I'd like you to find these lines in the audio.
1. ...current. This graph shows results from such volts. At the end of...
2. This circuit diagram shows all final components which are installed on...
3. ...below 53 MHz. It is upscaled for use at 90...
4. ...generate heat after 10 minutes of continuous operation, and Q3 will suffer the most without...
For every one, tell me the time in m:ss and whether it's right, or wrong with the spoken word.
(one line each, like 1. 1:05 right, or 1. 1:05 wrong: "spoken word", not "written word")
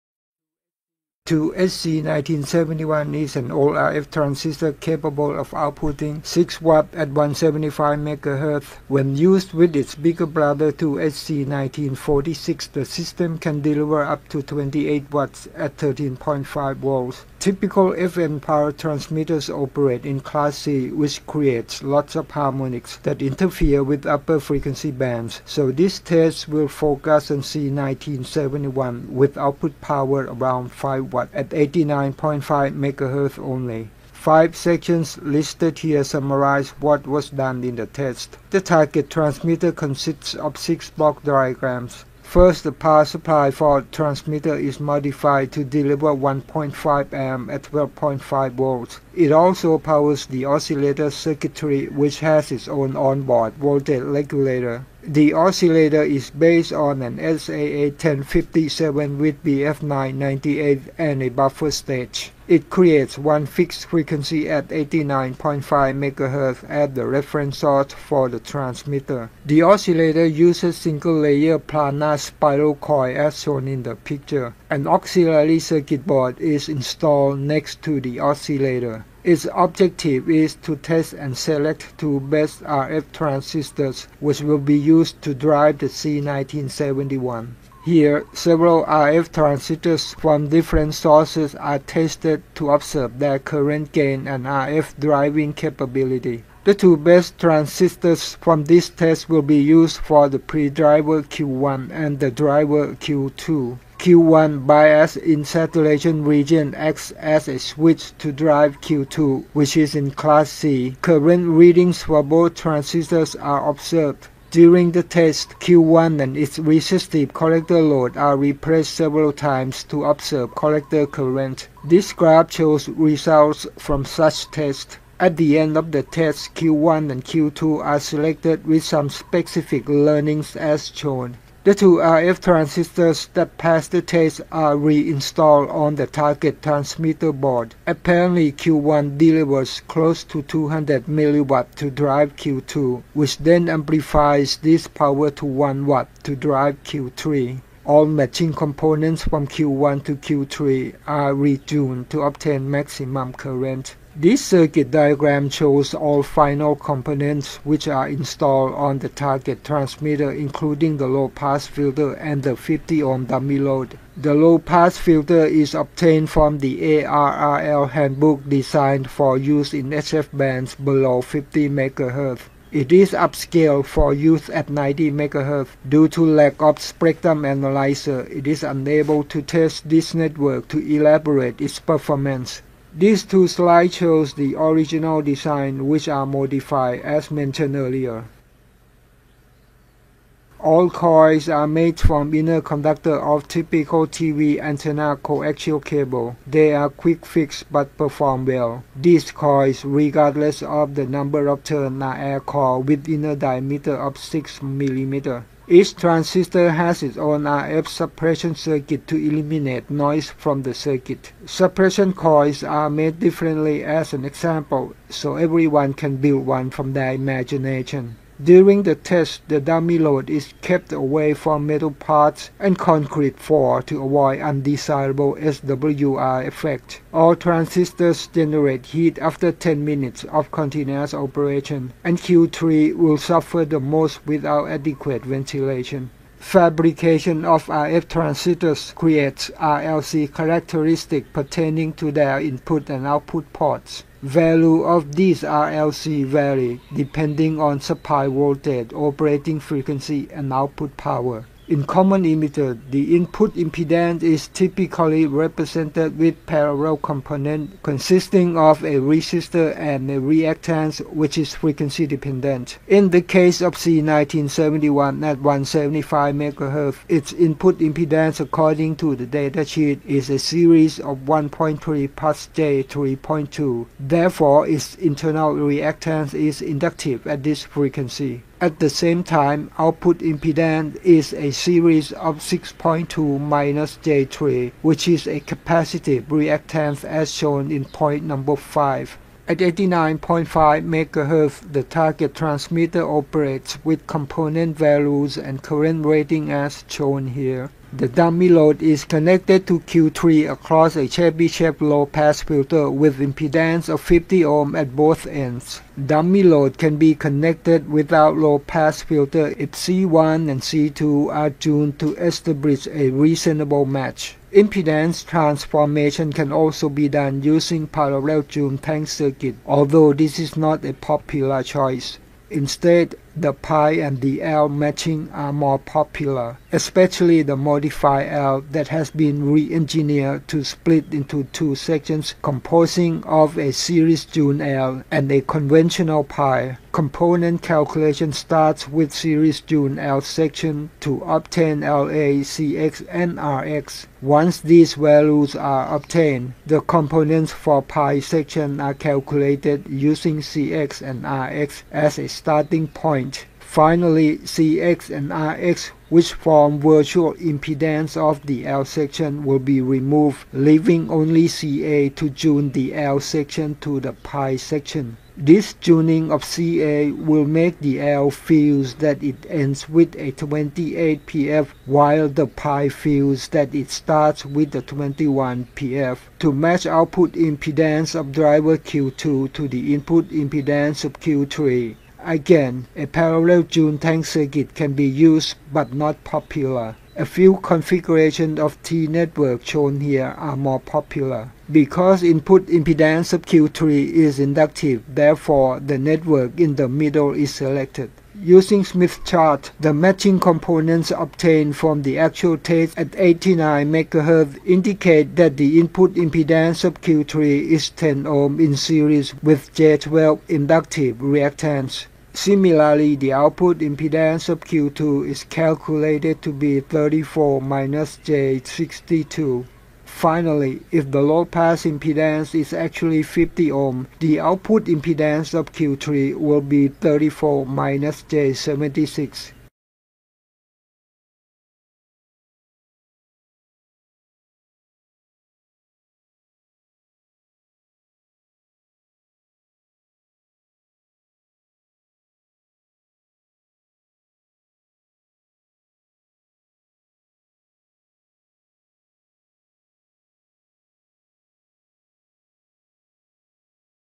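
1. 2:01 wrong: "tests", not "volts"
2. 2:34 right
3. 2:50 wrong: "50", not "53"
4. 3:48 right.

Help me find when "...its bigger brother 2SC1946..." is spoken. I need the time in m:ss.
0:09.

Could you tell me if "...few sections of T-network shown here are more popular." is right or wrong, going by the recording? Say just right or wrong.
wrong.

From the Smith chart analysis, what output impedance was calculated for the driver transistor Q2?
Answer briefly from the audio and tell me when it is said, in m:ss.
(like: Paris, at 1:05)
34 - j62, at 6:56.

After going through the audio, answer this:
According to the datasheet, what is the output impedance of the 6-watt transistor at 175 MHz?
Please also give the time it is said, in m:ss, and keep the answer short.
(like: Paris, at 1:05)
6.2 - j3, at 4:42.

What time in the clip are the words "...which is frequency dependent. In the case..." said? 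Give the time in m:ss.
4:21.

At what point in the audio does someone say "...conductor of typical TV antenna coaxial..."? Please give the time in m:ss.
3:12.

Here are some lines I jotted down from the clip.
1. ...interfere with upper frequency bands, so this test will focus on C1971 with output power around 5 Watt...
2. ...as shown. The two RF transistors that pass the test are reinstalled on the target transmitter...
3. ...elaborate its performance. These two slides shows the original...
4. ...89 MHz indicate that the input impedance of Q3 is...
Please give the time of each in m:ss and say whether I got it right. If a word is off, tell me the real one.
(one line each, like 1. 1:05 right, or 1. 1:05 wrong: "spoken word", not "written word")
1. 0:23 right
2. 2:10 right
3. 3:00 right
4. 6:43 right.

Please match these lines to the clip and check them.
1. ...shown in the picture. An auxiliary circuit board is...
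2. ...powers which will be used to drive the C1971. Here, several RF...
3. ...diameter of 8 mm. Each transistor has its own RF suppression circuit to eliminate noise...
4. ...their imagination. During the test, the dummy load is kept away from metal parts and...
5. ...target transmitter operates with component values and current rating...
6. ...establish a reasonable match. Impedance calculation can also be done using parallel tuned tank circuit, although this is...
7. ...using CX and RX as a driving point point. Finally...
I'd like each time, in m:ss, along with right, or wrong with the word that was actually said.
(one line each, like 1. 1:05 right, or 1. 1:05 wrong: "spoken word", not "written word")
1. 1:13 right
2. 1:23 wrong: "transistors", not "powers"
3. 3:23 wrong: "6", not "8"
4. 3:36 right
5. 4:51 right
6. 5:12 wrong: "transformation", not "calculation"
7. 5:49 wrong: "starting", not "driving".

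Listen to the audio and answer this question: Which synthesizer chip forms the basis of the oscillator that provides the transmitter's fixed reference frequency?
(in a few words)
SAA 1057.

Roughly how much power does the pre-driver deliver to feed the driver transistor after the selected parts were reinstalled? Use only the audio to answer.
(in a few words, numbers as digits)
200 mW.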